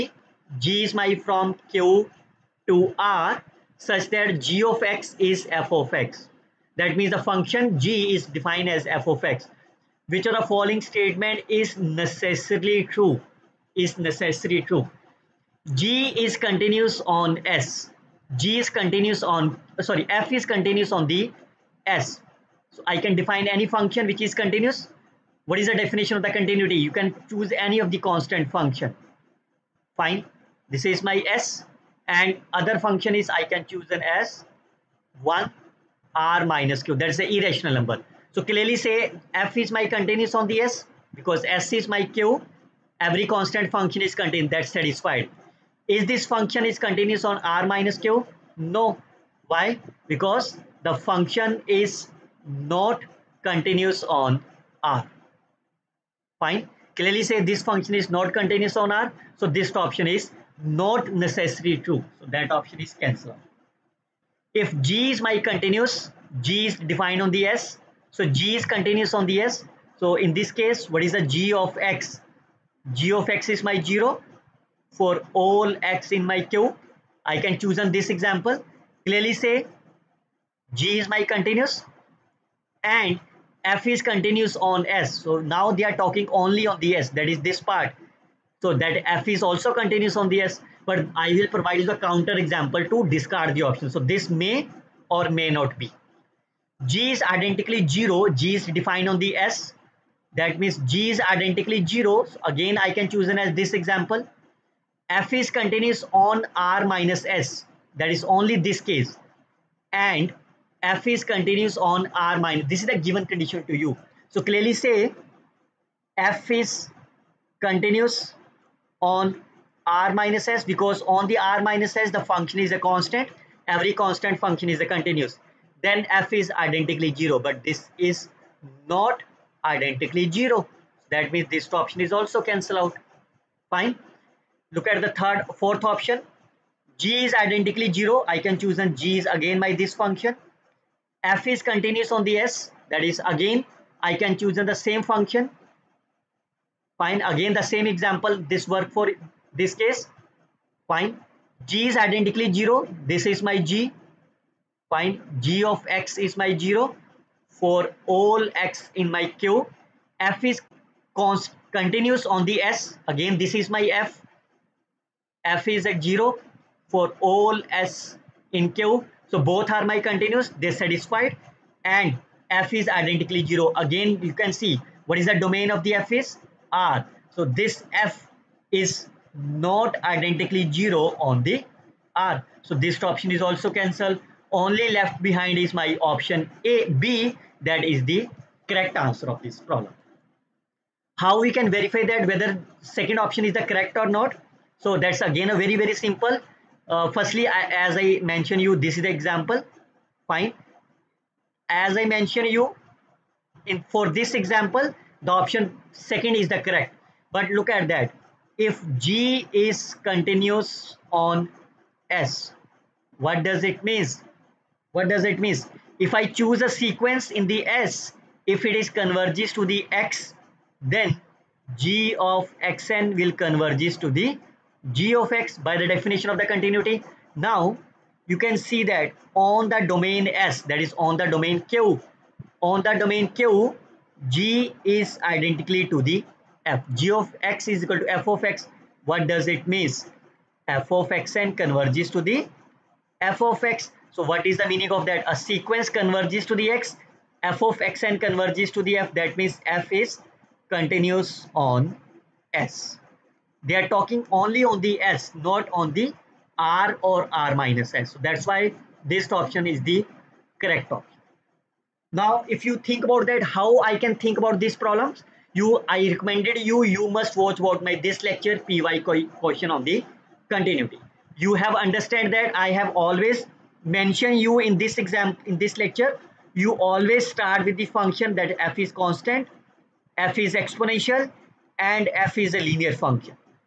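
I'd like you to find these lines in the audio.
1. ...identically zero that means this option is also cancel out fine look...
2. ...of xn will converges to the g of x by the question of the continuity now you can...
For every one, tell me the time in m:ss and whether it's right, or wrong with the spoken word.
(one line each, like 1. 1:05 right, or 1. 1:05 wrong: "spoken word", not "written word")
1. 2:09 right
2. 3:42 wrong: "definition", not "question".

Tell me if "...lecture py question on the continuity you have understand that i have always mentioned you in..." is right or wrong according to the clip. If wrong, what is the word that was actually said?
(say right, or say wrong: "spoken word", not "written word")
right.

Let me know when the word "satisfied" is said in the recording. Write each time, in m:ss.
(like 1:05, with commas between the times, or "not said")
0:44, 2:50.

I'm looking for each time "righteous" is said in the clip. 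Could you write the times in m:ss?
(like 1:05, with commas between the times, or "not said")
not said.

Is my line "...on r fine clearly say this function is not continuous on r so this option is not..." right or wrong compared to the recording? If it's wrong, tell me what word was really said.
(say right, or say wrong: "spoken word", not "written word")
right.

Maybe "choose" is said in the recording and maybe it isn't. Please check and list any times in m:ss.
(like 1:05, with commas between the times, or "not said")
0:27, 0:33, 1:17, 1:43, 2:18, 2:24, 3:36.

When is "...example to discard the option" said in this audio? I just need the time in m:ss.
1:32.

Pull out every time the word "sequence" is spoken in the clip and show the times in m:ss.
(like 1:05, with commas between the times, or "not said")
3:36, 4:05.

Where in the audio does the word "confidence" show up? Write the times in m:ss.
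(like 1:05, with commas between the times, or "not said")
not said.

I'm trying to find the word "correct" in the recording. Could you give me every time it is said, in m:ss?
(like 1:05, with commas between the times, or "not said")
3:08, 3:13, 3:26, 4:20.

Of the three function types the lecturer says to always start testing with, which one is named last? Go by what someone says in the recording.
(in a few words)
linear function.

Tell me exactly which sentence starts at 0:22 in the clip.
So I can define any function which is continuous.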